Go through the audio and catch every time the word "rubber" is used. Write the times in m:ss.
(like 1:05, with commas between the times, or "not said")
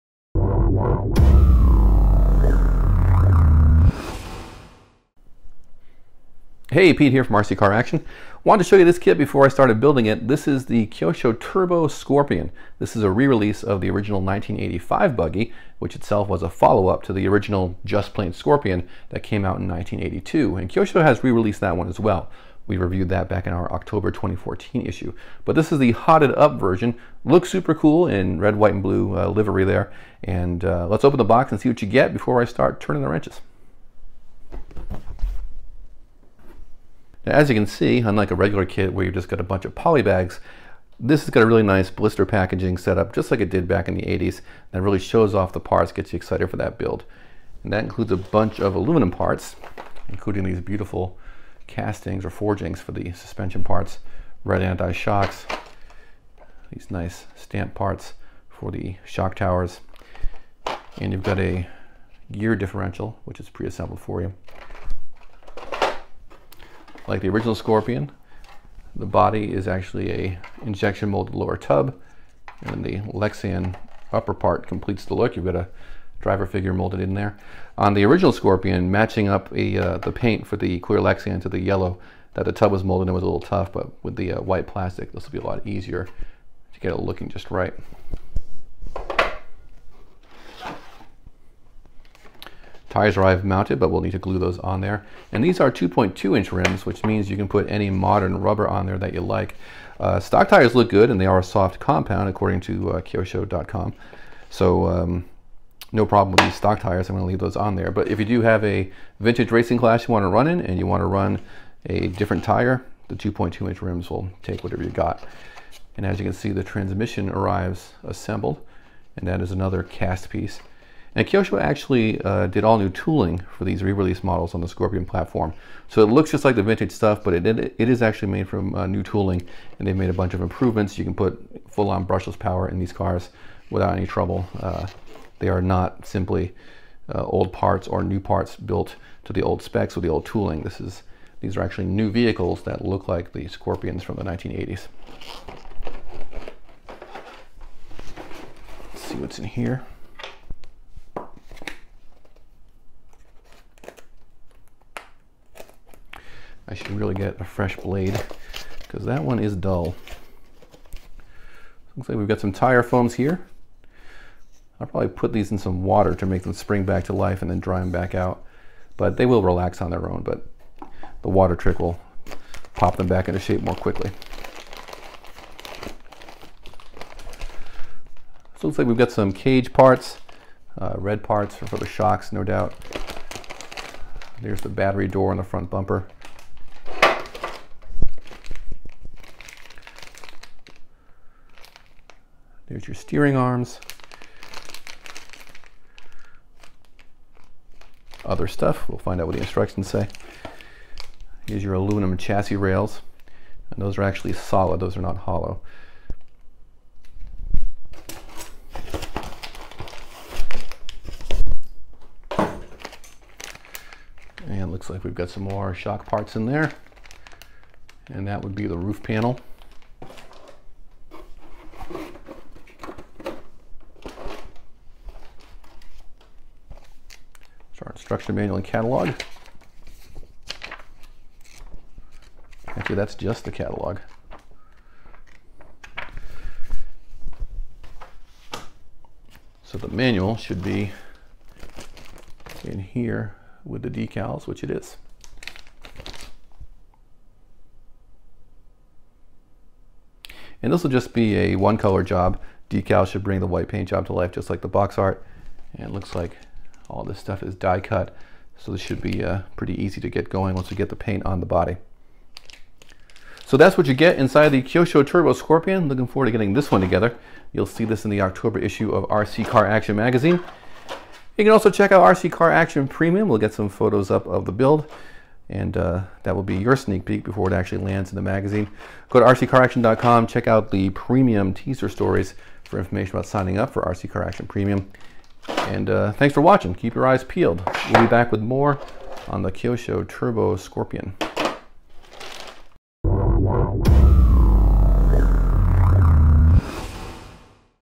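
1:38.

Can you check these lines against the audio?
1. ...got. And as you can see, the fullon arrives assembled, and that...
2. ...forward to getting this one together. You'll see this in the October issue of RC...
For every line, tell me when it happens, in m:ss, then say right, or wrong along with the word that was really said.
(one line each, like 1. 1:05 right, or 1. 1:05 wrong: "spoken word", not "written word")
1. 1:54 wrong: "transmission", not "fullon"
2. 4:26 right.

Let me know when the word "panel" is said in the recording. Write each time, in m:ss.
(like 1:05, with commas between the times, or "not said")
3:39.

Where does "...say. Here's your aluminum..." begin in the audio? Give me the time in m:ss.
3:19.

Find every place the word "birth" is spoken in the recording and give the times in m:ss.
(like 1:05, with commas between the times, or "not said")
not said.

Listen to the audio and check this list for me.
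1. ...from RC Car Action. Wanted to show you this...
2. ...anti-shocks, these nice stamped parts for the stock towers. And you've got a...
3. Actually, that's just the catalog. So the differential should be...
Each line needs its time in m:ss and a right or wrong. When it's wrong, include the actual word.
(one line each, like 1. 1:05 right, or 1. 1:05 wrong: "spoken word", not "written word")
1. 0:07 right
2. 0:54 wrong: "shock", not "stock"
3. 3:52 wrong: "manual", not "differential".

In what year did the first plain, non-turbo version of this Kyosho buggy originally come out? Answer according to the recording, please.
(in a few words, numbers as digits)
1982.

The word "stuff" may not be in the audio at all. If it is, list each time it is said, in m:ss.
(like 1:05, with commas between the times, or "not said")
2:06, 3:18, 4:17.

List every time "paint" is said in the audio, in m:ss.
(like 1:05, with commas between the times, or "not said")
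1:20, 4:13, 4:20.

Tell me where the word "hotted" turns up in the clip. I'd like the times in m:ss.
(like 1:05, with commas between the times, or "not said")
0:25.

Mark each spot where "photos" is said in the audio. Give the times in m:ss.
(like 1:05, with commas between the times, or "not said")
4:33.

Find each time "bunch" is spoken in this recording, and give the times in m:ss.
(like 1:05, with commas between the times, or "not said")
0:39, 0:48, 2:10.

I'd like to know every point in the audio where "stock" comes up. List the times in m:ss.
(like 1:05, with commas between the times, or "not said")
1:40, 1:46.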